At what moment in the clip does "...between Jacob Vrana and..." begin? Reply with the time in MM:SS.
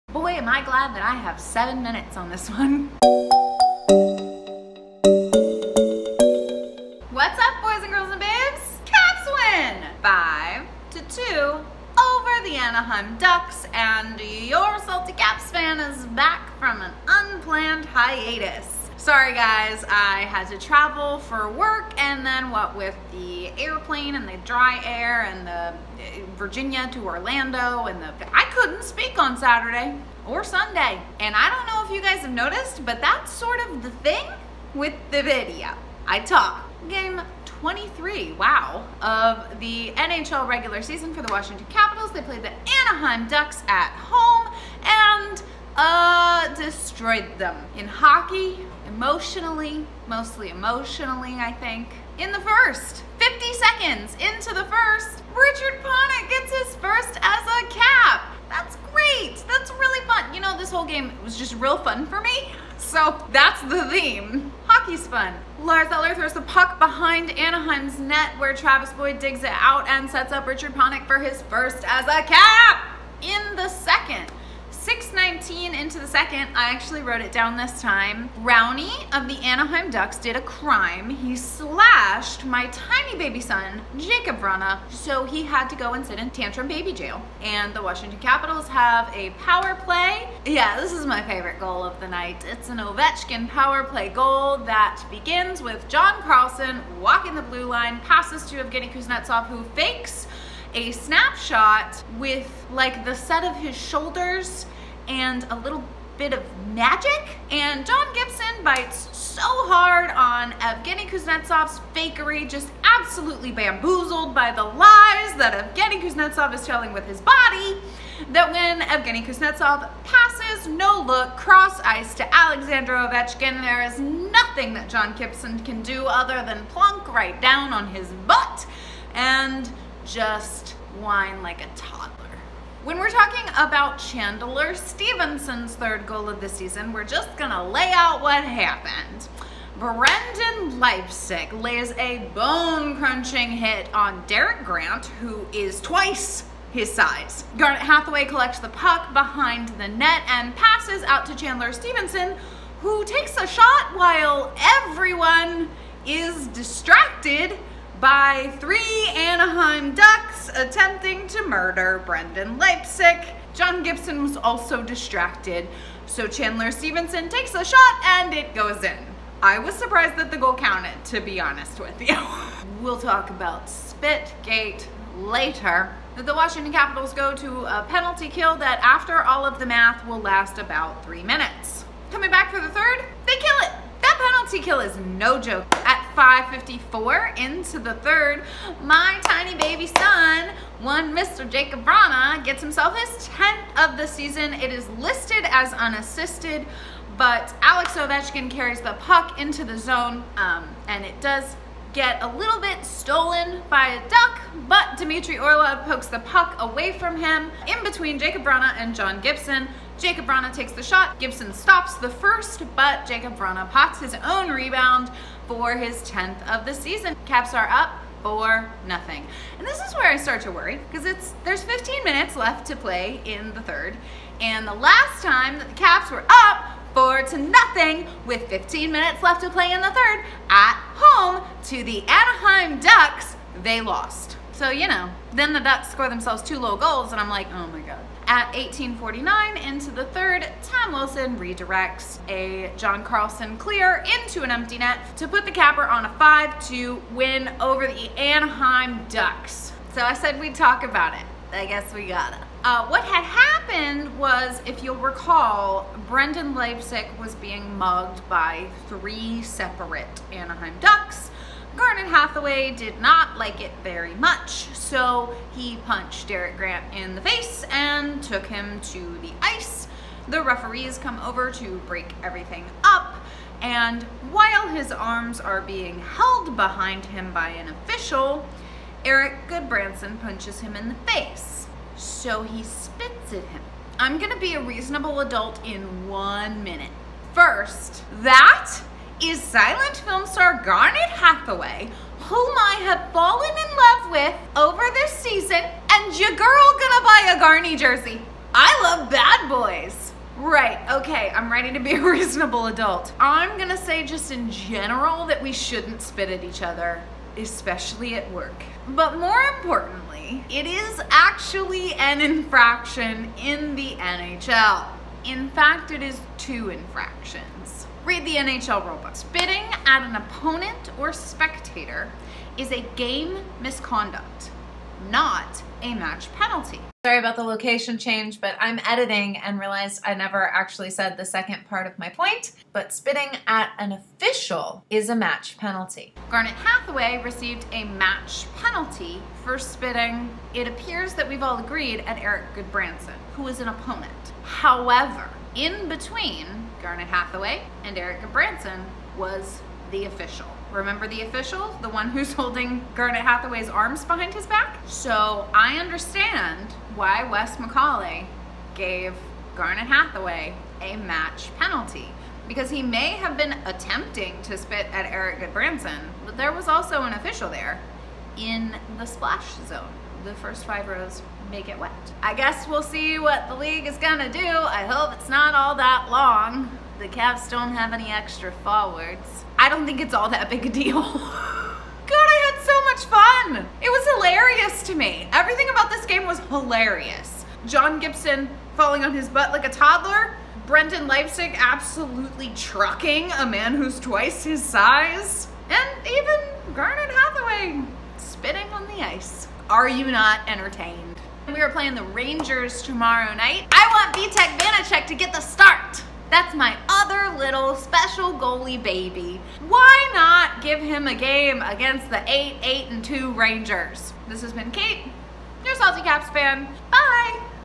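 03:27.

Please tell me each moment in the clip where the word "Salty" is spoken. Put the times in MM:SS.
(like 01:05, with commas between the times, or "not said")
00:14, 06:55.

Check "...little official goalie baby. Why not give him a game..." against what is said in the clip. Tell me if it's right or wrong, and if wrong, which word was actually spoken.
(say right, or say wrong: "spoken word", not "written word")
wrong: "special", not "official".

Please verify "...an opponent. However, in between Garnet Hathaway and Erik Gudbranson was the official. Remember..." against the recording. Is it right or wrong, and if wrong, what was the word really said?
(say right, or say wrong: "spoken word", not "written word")
right.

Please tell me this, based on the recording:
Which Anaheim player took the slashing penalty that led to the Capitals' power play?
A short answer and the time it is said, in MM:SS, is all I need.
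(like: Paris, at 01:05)
Rowney, at 01:18.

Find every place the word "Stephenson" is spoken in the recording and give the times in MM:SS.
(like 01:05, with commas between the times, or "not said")
02:14, 02:31, 02:46.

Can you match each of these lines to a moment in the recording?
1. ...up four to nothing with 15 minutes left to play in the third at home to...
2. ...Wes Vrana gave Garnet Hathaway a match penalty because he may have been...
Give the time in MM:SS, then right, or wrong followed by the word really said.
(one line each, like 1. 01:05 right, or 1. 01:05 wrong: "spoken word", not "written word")
1. 03:46 right
2. 05:57 wrong: "McCauley", not "Vrana".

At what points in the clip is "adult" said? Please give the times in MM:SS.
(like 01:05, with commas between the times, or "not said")
04:45, 05:02.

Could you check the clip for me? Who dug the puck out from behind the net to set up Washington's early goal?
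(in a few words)
Travis Boyd.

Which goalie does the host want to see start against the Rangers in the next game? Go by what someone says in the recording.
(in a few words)
Vitek Vanecek.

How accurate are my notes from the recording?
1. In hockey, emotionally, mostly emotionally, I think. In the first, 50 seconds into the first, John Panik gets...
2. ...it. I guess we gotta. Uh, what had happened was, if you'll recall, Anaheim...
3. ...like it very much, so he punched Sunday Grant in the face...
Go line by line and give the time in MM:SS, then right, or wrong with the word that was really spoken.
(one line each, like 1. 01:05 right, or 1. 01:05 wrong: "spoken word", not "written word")
1. 00:47 wrong: "Richard", not "John"
2. 04:11 wrong: "Brendan", not "Anaheim"
3. 04:23 wrong: "Derek", not "Sunday".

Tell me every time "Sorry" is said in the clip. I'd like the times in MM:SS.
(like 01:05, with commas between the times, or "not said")
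00:19, 05:27.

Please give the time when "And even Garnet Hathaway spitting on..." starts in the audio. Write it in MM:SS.
06:35.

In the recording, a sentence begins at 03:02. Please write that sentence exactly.
Coming back for the third, they kill it.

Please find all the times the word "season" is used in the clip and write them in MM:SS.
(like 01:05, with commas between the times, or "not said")
00:40, 02:16, 03:14, 03:36, 04:55.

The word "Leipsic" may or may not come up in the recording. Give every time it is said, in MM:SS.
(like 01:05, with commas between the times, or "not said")
02:20, 02:42, 04:16, 06:31.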